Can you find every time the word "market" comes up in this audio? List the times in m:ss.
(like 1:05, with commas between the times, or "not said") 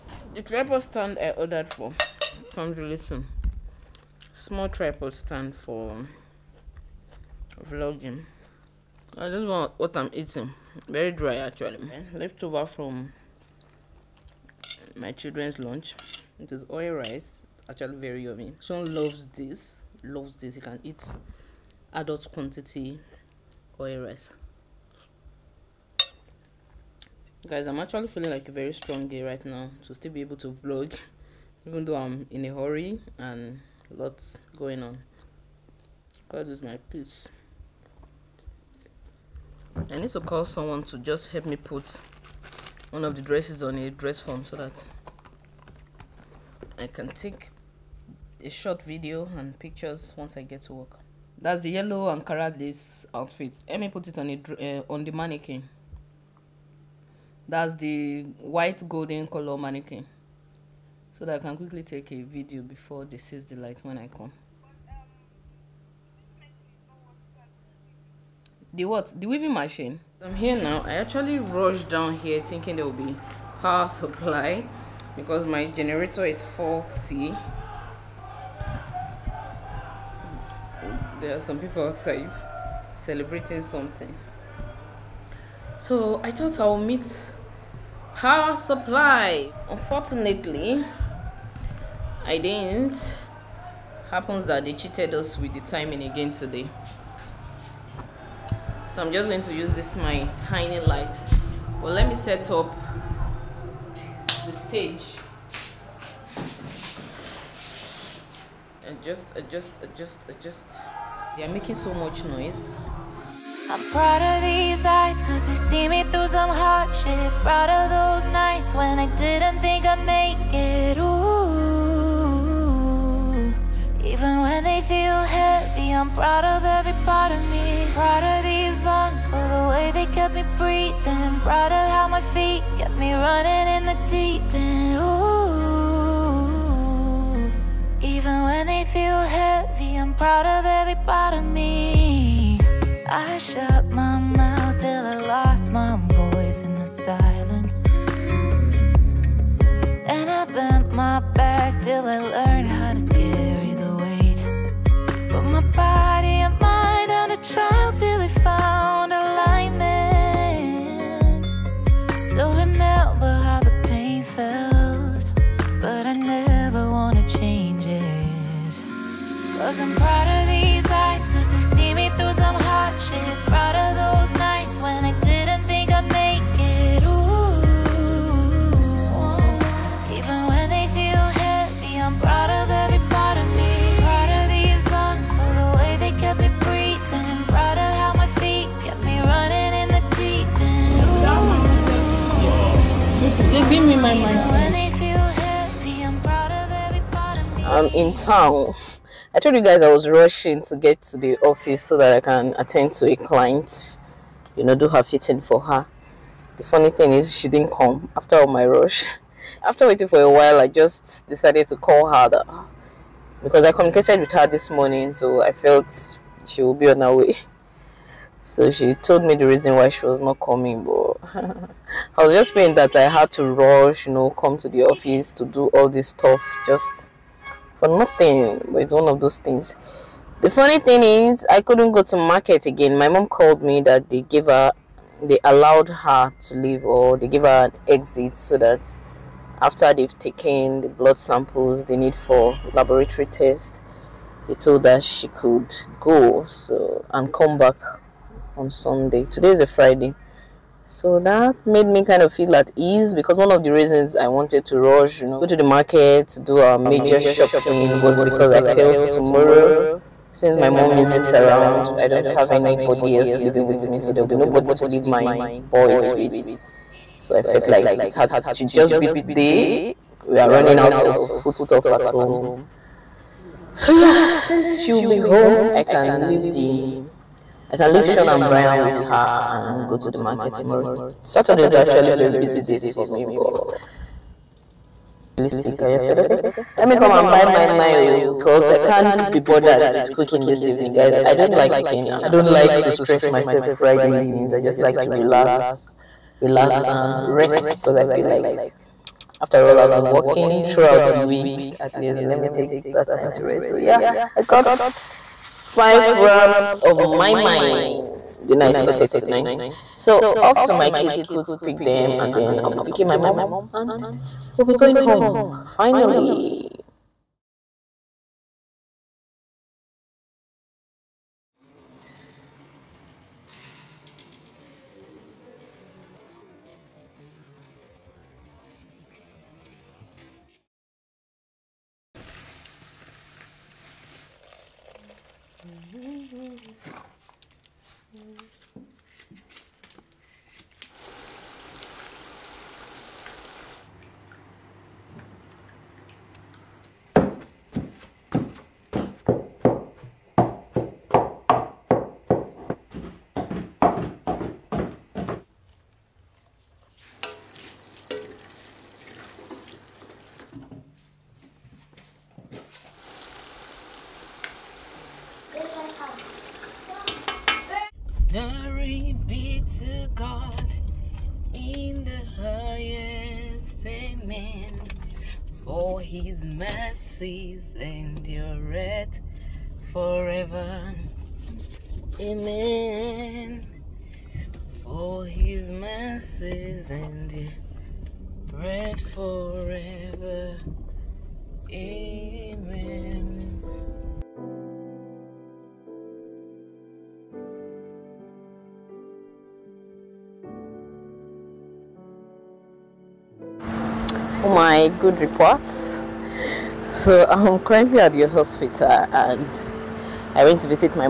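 3:52, 4:15, 4:40.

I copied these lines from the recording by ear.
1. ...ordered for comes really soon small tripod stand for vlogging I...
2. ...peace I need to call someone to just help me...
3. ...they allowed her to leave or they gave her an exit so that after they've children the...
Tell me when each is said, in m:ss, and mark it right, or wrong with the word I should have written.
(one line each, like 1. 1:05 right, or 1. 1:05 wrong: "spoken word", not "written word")
1. 0:01 right
2. 0:36 right
3. 3:55 wrong: "taken", not "children".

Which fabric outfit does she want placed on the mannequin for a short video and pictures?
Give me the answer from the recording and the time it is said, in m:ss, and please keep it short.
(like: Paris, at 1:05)
yellow Ankara lace outfit, at 0:51.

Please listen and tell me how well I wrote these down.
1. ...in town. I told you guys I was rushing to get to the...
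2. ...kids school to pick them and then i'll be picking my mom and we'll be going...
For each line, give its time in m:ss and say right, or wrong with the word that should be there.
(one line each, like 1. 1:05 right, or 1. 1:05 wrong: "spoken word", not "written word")
1. 3:17 right
2. 5:10 right.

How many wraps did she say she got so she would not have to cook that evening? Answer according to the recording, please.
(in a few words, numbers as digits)
5.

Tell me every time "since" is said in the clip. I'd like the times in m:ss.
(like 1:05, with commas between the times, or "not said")
4:20, 4:34.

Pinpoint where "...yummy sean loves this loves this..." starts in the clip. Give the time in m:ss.
0:18.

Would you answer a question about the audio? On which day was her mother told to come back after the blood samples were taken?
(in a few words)
Sunday.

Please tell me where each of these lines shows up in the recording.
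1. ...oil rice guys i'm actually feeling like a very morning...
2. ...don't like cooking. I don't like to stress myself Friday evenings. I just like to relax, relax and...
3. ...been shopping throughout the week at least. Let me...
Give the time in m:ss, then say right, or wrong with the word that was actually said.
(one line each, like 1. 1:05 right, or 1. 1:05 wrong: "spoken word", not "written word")
1. 0:23 wrong: "strong", not "morning"
2. 4:51 right
3. 4:59 wrong: "working", not "shopping".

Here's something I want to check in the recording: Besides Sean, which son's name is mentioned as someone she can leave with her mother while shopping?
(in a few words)
Brian.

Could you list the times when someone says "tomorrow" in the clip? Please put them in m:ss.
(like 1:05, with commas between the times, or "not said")
4:18, 4:40.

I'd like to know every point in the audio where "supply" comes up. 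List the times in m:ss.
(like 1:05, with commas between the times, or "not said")
1:13, 1:28.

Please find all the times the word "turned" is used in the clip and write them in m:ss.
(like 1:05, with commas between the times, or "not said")
not said.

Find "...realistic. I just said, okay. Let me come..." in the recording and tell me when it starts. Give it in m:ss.
4:45.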